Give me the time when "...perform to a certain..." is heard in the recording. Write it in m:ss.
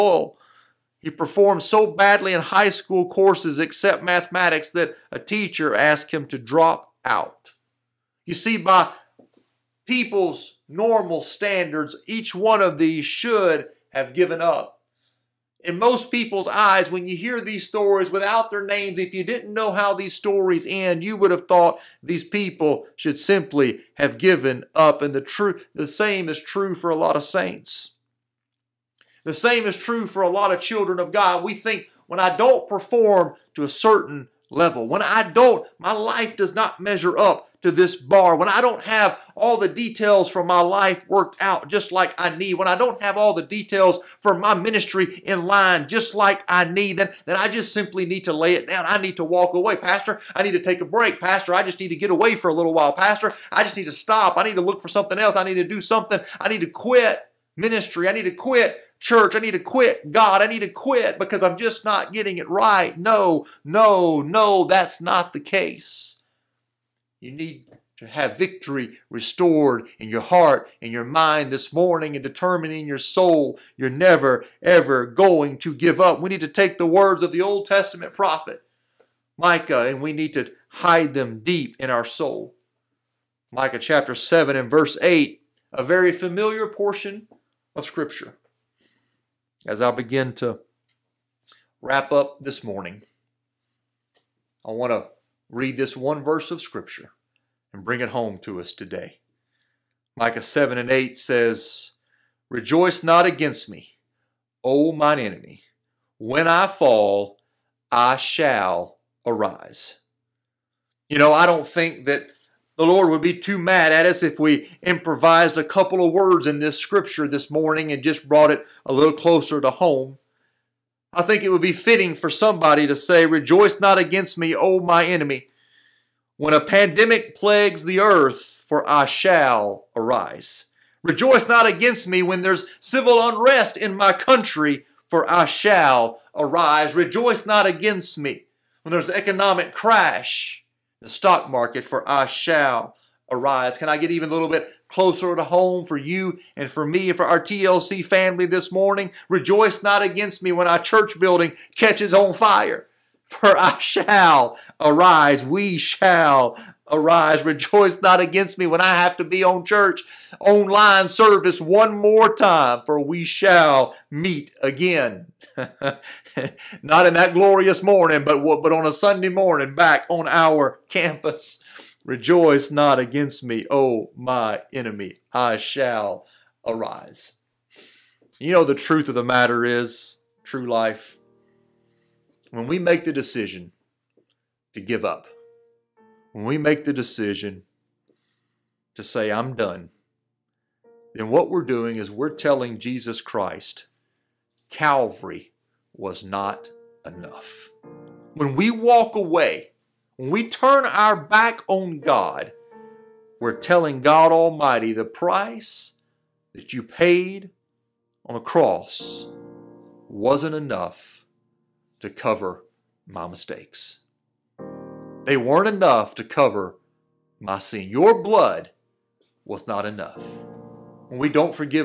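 0:32.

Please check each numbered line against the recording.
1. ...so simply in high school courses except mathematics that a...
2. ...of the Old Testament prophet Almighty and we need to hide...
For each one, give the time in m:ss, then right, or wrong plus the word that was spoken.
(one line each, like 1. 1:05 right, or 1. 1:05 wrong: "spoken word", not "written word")
1. 0:01 wrong: "badly", not "simply"
2. 1:17 wrong: "Micah", not "Almighty".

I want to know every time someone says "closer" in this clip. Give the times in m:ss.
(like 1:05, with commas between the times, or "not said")
1:59, 2:24.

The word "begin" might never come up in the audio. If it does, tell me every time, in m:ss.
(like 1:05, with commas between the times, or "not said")
1:29.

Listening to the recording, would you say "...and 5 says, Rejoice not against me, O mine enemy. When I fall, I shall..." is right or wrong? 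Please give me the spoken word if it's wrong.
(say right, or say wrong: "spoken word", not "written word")
wrong: "8", not "5".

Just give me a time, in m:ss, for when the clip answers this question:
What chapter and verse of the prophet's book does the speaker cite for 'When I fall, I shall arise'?
1:23.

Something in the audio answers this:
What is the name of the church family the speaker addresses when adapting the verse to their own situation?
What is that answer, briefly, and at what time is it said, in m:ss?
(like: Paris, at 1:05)
TLC, at 2:27.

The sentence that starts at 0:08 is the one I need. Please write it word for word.
You see, by people's normal standards, each one of these should have given up.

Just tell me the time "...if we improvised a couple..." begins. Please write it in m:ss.
1:54.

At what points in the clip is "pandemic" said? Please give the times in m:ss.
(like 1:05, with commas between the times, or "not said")
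2:06.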